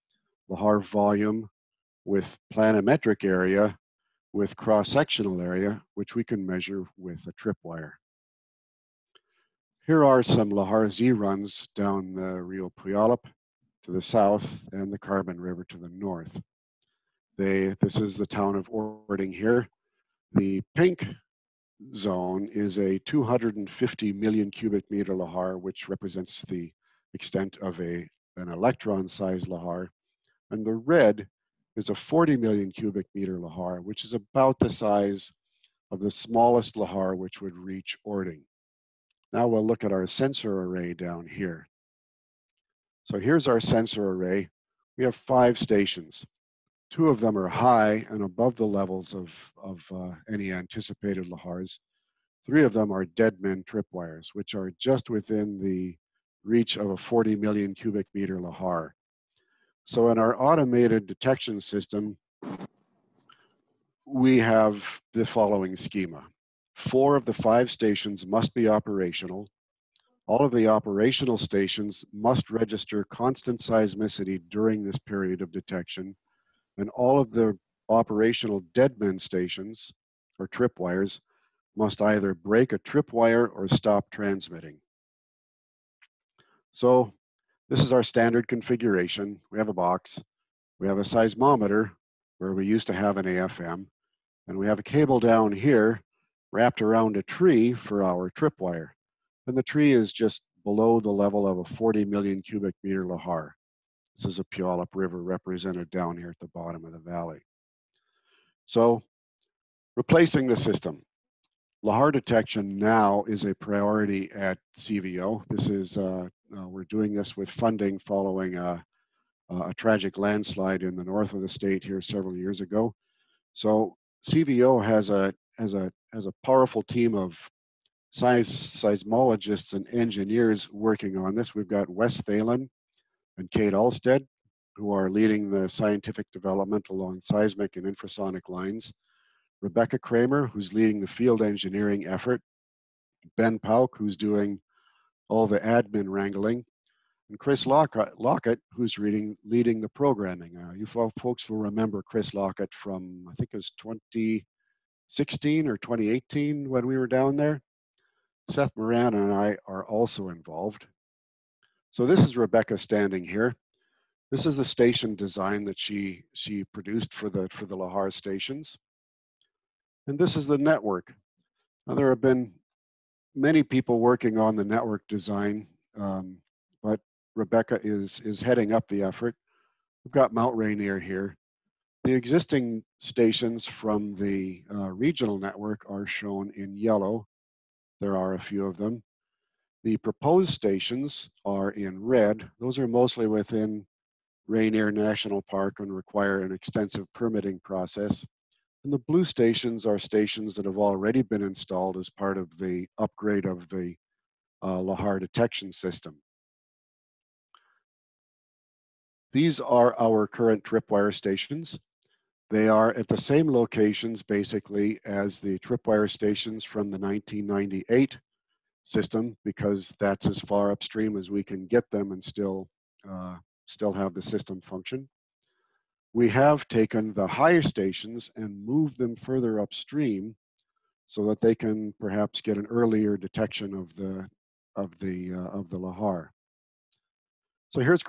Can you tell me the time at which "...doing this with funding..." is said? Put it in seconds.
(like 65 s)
116 s.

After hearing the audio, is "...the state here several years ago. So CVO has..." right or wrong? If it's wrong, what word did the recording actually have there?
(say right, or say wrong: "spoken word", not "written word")
right.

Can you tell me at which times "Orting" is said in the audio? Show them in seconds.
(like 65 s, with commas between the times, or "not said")
18 s, 38 s.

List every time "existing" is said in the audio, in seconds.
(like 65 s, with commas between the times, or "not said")
182 s.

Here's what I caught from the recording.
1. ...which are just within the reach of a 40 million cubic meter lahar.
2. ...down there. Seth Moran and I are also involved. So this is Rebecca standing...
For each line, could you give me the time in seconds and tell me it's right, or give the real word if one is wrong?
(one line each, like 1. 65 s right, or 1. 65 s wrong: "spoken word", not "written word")
1. 54 s right
2. 157 s right.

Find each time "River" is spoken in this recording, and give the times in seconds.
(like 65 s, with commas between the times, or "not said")
15 s, 104 s.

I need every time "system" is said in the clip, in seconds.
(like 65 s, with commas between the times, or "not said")
61 s, 110 s, 205 s, 218 s, 224 s.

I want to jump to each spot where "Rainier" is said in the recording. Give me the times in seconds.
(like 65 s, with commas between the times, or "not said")
180 s, 194 s.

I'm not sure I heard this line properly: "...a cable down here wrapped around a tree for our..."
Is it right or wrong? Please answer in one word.
right.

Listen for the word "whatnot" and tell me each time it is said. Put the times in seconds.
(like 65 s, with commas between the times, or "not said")
not said.